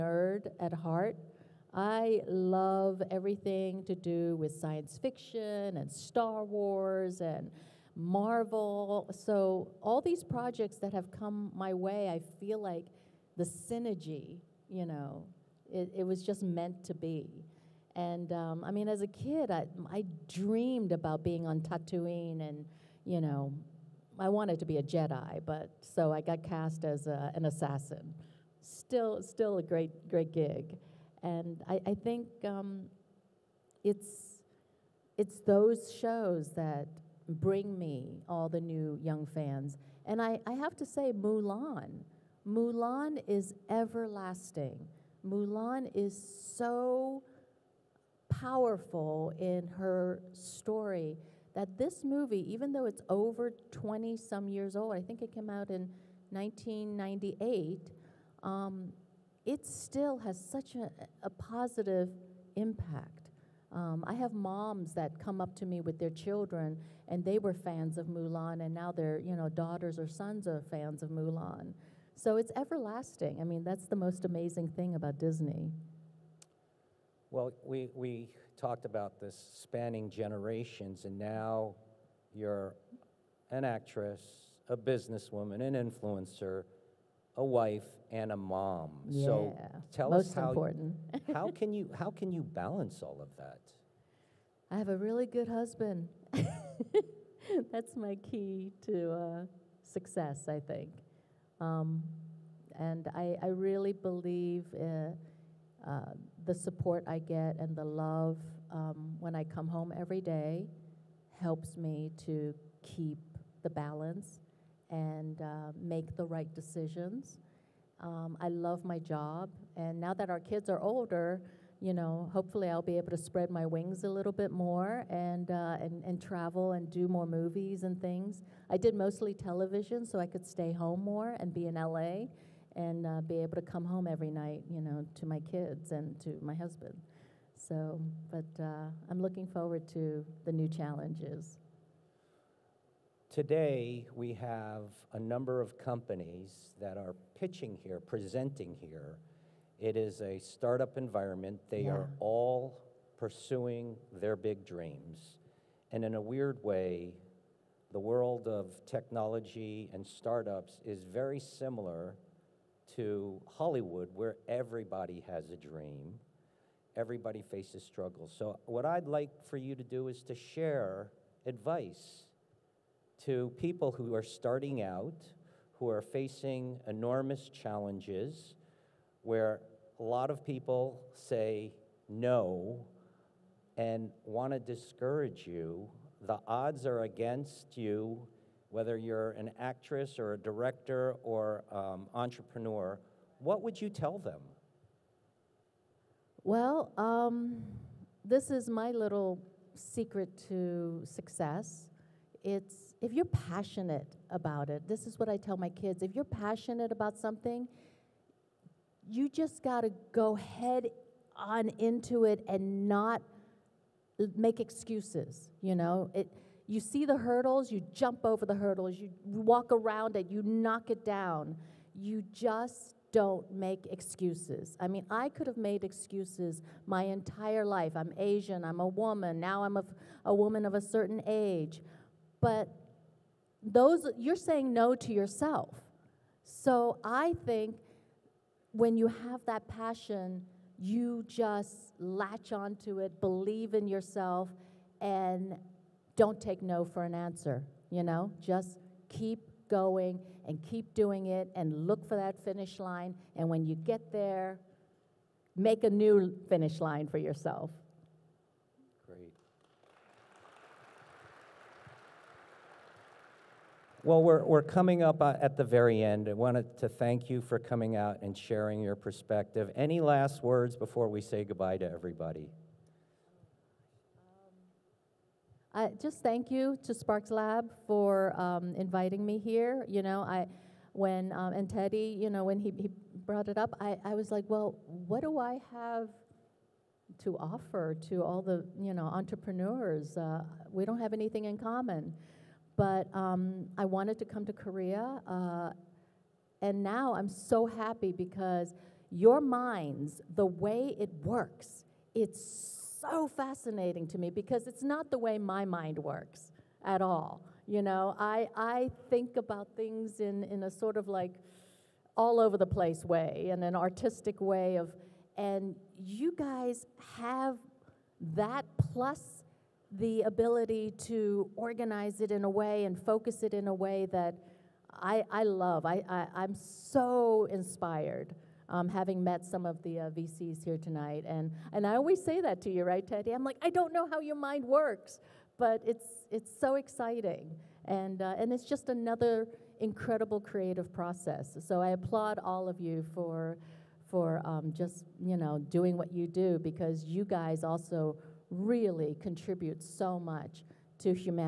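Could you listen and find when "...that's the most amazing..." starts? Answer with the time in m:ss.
1:13.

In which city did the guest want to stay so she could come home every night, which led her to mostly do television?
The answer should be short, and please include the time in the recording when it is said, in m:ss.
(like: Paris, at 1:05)
LA, at 2:11.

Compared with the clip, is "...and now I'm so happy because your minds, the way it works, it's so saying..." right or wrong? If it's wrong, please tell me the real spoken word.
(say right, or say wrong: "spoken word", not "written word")
wrong: "fascinating", not "saying".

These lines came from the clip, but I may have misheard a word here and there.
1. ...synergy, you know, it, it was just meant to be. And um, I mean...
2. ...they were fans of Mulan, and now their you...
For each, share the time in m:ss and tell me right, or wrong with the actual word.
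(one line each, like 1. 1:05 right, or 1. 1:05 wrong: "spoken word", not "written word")
1. 0:13 right
2. 1:07 right.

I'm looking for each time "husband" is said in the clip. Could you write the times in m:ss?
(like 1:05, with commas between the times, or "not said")
1:35, 2:16.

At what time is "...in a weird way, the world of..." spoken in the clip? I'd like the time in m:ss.
2:36.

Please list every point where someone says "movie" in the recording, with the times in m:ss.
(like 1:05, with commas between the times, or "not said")
0:52, 2:07.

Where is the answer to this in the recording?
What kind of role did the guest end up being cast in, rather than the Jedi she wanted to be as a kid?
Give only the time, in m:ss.
0:27.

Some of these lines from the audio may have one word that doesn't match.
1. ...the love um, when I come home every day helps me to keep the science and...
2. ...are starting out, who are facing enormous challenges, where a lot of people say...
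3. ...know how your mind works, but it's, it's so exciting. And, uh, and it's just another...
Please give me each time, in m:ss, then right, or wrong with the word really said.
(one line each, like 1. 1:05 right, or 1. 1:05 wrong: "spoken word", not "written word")
1. 1:47 wrong: "balance", not "science"
2. 2:54 right
3. 5:33 right.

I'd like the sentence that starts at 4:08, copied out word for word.
Just keep going and keep doing it and look for that finish line.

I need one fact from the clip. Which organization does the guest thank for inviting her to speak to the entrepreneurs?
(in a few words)
Sparks Lab.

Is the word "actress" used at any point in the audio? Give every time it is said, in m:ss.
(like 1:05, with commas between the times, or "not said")
1:23, 3:09.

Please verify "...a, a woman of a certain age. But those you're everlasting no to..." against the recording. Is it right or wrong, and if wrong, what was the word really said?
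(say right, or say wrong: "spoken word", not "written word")
wrong: "saying", not "everlasting".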